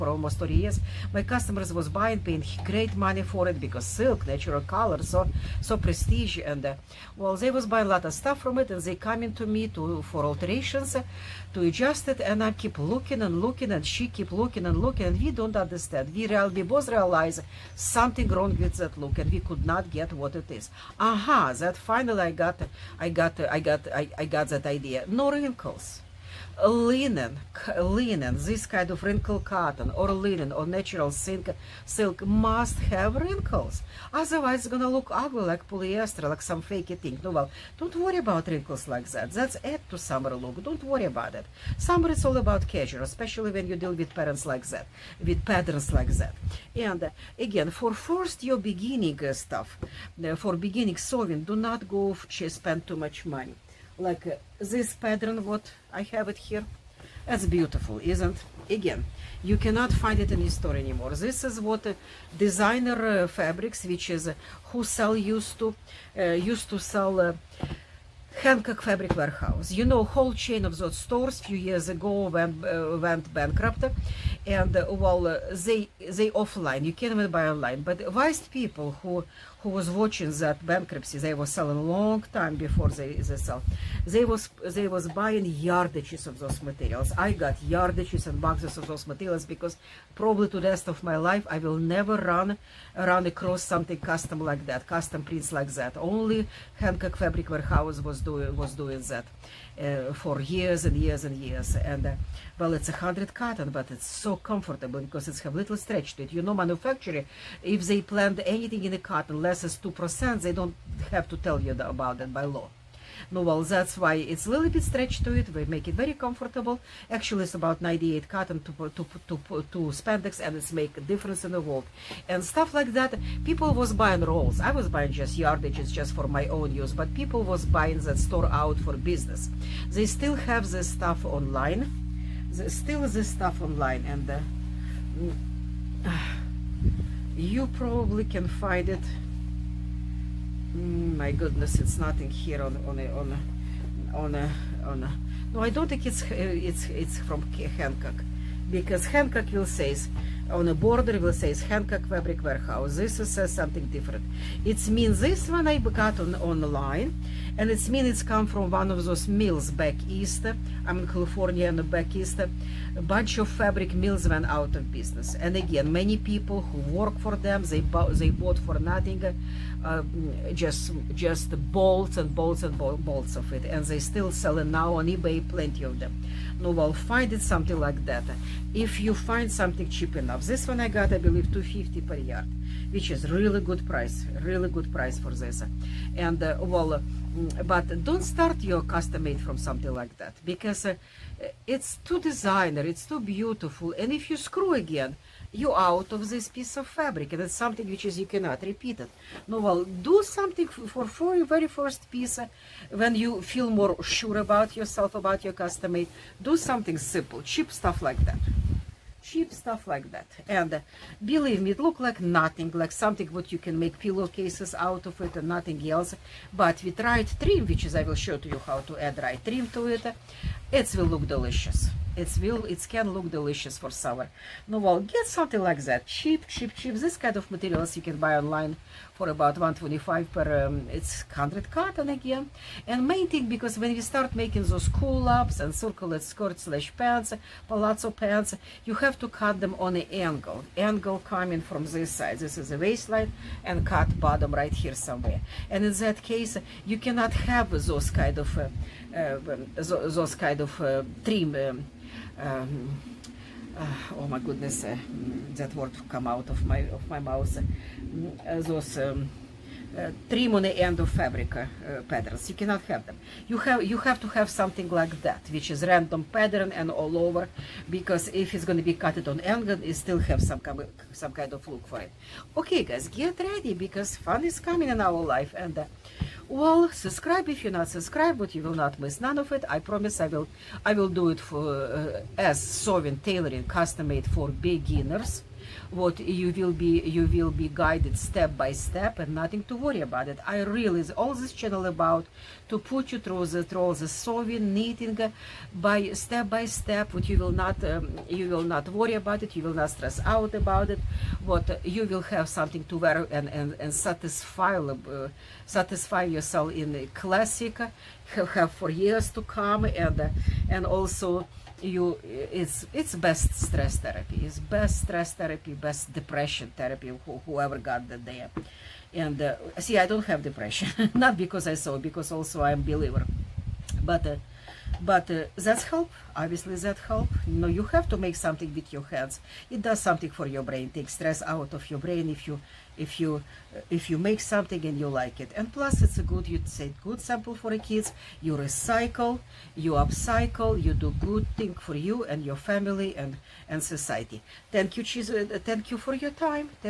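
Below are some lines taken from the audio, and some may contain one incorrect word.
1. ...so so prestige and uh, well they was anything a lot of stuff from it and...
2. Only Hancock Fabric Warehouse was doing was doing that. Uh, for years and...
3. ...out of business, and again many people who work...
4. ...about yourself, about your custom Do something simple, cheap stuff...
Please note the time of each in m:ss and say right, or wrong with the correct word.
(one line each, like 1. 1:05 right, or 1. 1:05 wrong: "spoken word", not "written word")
1. 0:05 wrong: "buying", not "anything"
2. 1:35 right
3. 2:44 right
4. 3:24 right.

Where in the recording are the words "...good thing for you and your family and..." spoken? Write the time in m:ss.
5:41.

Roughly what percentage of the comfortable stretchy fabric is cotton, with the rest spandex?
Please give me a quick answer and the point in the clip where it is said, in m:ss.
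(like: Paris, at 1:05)
98, at 1:57.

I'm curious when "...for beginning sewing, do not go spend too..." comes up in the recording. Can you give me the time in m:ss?
0:50.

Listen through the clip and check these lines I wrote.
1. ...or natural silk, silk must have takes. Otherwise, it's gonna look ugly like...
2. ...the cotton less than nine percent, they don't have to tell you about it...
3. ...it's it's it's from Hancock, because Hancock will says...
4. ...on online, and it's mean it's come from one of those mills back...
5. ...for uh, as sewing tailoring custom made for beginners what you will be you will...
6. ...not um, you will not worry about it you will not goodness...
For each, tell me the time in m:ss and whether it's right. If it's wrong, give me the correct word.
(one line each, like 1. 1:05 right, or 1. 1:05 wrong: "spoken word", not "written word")
1. 0:30 wrong: "wrinkles", not "takes"
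2. 1:48 wrong: "two", not "nine"
3. 2:26 right
4. 2:36 right
5. 4:41 right
6. 4:57 wrong: "stress", not "goodness".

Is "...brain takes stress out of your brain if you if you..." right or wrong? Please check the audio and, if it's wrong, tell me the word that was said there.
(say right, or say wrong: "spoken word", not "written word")
right.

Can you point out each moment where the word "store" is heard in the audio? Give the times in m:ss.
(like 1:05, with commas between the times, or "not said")
1:00, 1:10, 2:08.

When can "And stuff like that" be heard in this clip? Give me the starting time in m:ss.
2:02.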